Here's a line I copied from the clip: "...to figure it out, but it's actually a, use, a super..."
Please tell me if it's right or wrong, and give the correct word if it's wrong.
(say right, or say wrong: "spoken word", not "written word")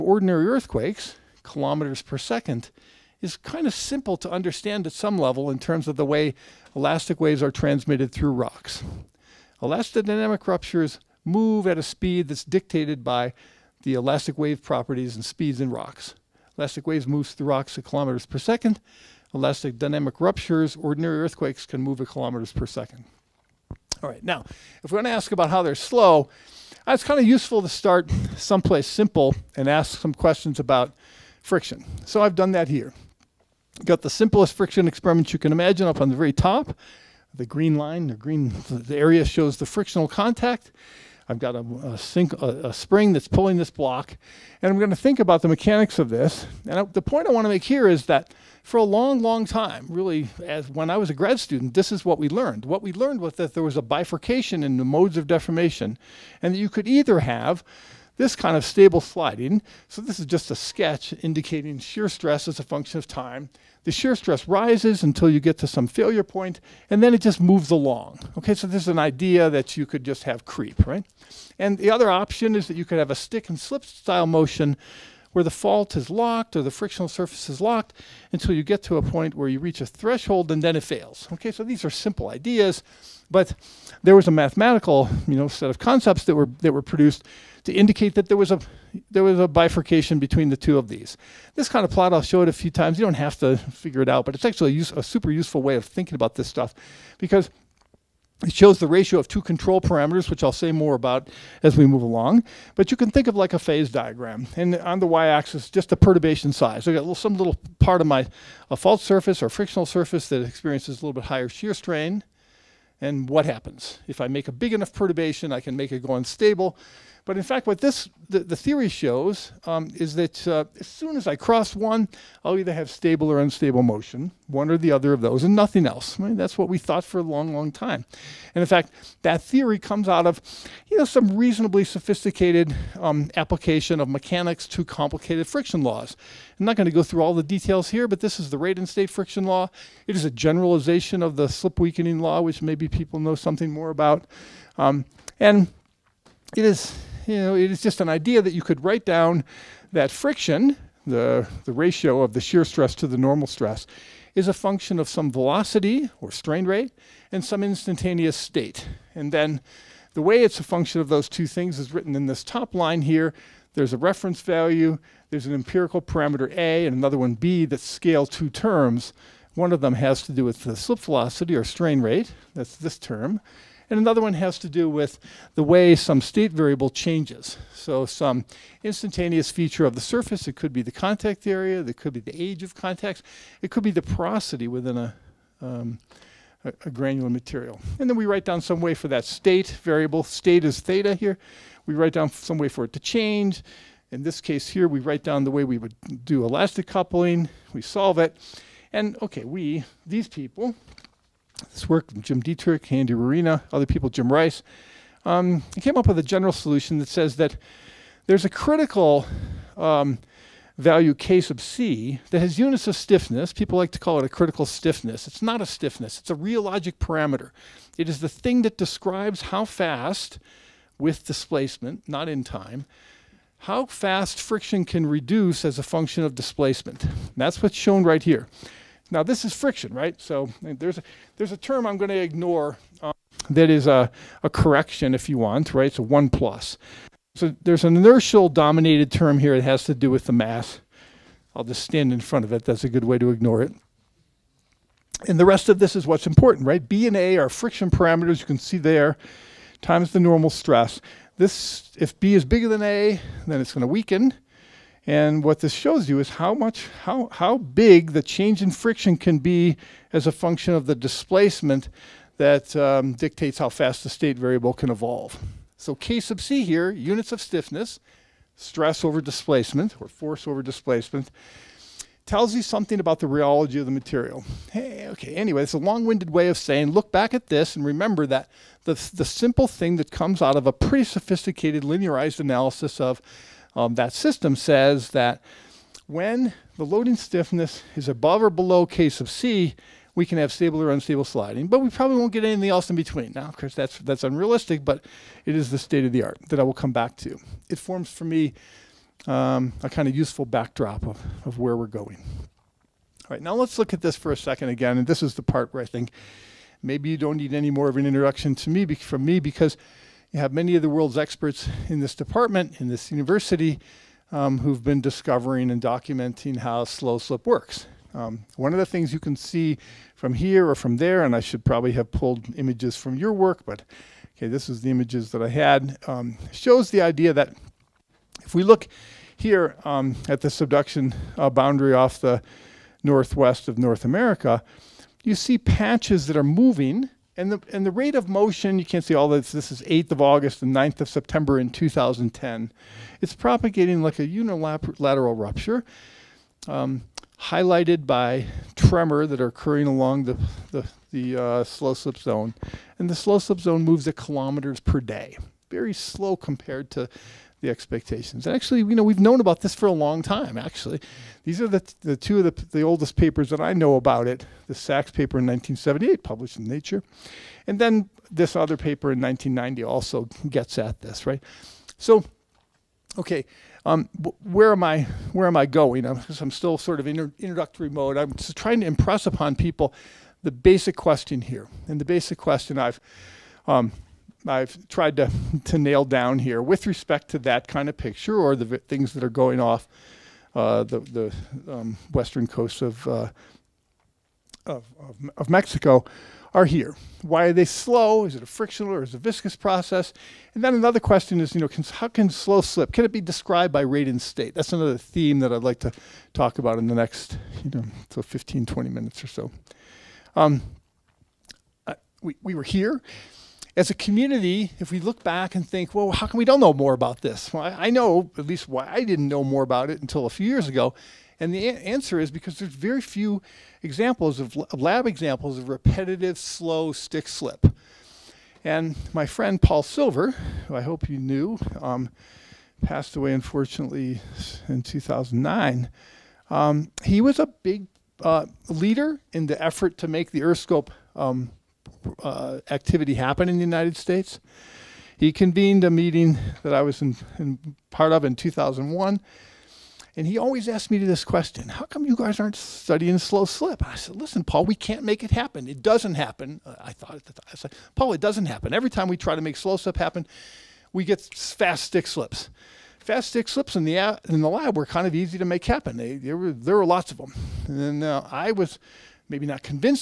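right.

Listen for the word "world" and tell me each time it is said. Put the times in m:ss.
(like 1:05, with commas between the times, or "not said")
5:10.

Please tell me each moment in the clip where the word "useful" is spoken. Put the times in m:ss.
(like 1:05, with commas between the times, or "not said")
0:27, 1:35, 5:00.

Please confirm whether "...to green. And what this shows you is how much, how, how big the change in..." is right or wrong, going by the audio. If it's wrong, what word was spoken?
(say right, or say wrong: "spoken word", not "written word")
wrong: "weaken", not "green".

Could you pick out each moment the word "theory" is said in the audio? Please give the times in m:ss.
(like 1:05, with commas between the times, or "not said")
1:58, 2:09.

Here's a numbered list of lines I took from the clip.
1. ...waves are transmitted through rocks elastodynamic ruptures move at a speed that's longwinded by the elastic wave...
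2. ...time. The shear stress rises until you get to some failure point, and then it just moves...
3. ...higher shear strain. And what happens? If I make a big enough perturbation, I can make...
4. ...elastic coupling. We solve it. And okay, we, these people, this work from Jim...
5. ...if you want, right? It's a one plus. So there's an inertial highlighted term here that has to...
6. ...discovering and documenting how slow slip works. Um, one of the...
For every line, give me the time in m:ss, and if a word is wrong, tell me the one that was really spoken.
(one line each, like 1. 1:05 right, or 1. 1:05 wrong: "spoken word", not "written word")
1. 0:07 wrong: "dictated", not "longwinded"
2. 1:03 right
3. 1:51 right
4. 3:16 right
5. 3:55 wrong: "dominated", not "highlighted"
6. 5:14 right.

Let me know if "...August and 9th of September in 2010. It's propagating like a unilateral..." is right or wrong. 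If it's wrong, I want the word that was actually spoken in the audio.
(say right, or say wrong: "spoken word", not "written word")
right.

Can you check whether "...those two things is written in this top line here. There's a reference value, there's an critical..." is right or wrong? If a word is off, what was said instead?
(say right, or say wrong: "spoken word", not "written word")
wrong: "empirical", not "critical".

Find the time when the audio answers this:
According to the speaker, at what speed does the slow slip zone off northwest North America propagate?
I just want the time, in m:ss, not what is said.
5:54.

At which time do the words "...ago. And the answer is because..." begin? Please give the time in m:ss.
7:00.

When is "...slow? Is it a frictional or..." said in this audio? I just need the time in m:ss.
6:37.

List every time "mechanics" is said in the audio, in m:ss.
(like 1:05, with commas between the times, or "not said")
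0:45, 2:14.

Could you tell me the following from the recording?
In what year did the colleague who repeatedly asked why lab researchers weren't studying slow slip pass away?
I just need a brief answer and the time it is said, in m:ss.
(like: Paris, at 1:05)
2009, at 7:14.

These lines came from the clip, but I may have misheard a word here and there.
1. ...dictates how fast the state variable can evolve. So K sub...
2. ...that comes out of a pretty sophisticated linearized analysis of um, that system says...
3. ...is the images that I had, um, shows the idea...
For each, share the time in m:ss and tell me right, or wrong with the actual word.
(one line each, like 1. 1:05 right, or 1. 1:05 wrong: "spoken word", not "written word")
1. 4:23 right
2. 4:39 right
3. 5:24 right.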